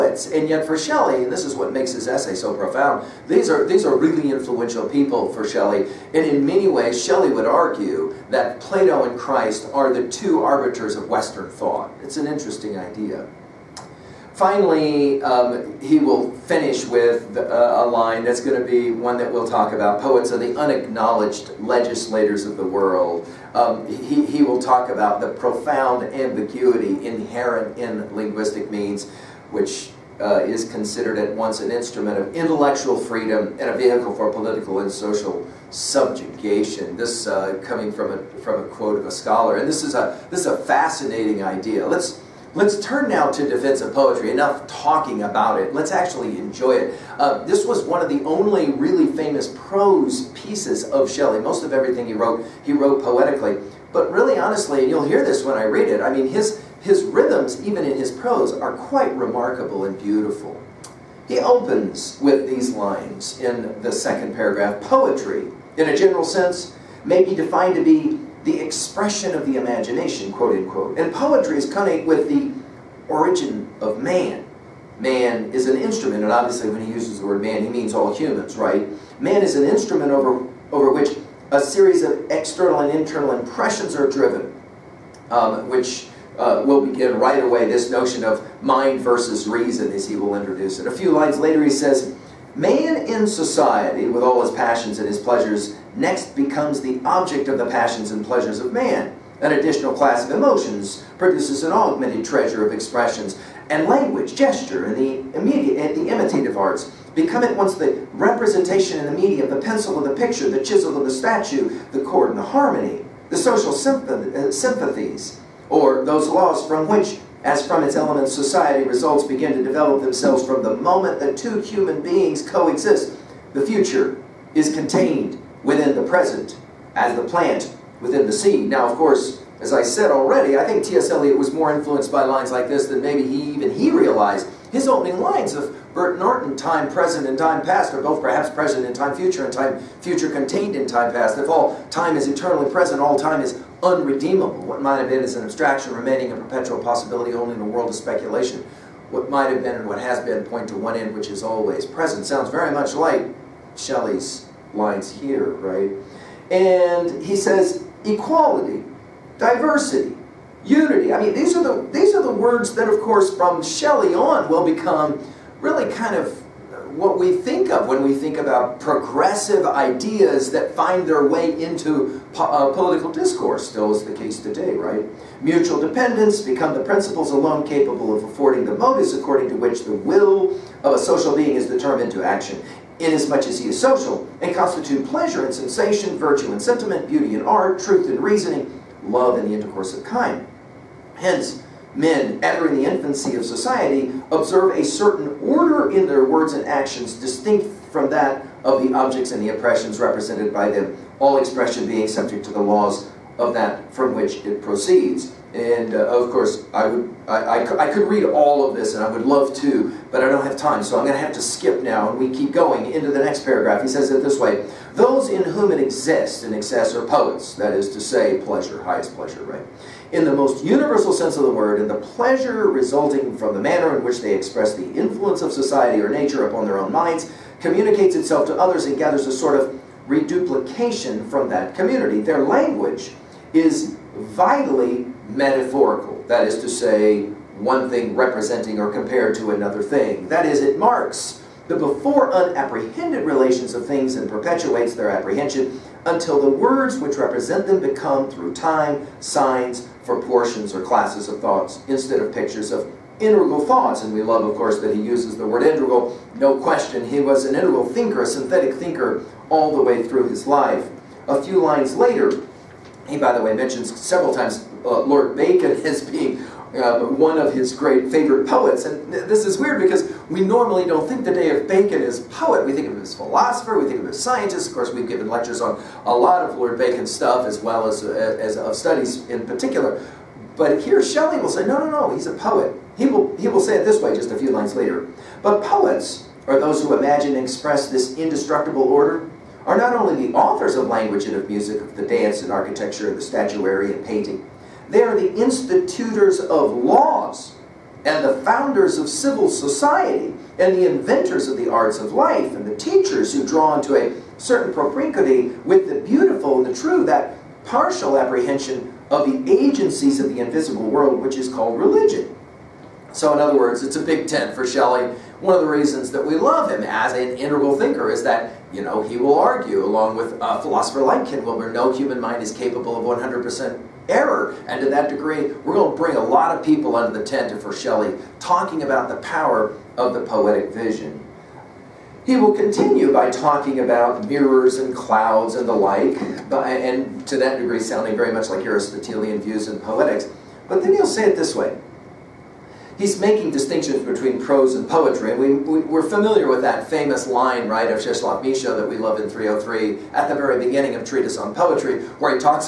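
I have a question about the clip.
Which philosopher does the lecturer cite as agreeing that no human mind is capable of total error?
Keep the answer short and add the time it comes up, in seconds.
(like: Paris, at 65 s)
Ken Wilber, at 321 s.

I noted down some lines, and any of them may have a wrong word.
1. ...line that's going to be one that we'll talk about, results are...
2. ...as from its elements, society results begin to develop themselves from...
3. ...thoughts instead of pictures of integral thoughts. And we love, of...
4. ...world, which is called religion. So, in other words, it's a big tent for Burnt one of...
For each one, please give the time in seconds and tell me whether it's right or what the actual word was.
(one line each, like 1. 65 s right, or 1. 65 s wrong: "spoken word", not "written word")
1. 17 s wrong: "poets", not "results"
2. 117 s right
3. 251 s right
4. 310 s wrong: "Shelley", not "Burnt".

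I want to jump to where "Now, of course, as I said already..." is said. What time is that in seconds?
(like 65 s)
128 s.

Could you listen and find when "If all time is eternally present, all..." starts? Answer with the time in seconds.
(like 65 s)
141 s.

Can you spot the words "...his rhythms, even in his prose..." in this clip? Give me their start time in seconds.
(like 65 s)
56 s.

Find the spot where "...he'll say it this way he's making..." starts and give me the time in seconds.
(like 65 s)
340 s.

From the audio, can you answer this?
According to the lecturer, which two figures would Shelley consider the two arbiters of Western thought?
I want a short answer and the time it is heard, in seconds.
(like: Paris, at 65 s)
Plato and Christ, at 8 s.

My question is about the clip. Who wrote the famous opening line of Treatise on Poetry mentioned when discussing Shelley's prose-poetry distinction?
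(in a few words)
Czeslaw Milosz.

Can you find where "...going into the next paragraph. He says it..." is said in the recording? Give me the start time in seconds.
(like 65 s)
212 s.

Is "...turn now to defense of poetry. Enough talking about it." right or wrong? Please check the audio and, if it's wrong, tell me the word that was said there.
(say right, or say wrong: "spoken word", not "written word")
right.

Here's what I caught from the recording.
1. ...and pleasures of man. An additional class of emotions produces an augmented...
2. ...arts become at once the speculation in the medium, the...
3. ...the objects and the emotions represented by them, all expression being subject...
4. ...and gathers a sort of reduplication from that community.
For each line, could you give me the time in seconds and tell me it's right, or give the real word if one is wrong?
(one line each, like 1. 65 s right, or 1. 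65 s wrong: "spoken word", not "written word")
1. 98 s right
2. 106 s wrong: "representation", not "speculation"
3. 198 s wrong: "oppressions", not "emotions"
4. 228 s right.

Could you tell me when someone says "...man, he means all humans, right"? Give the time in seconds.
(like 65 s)
77 s.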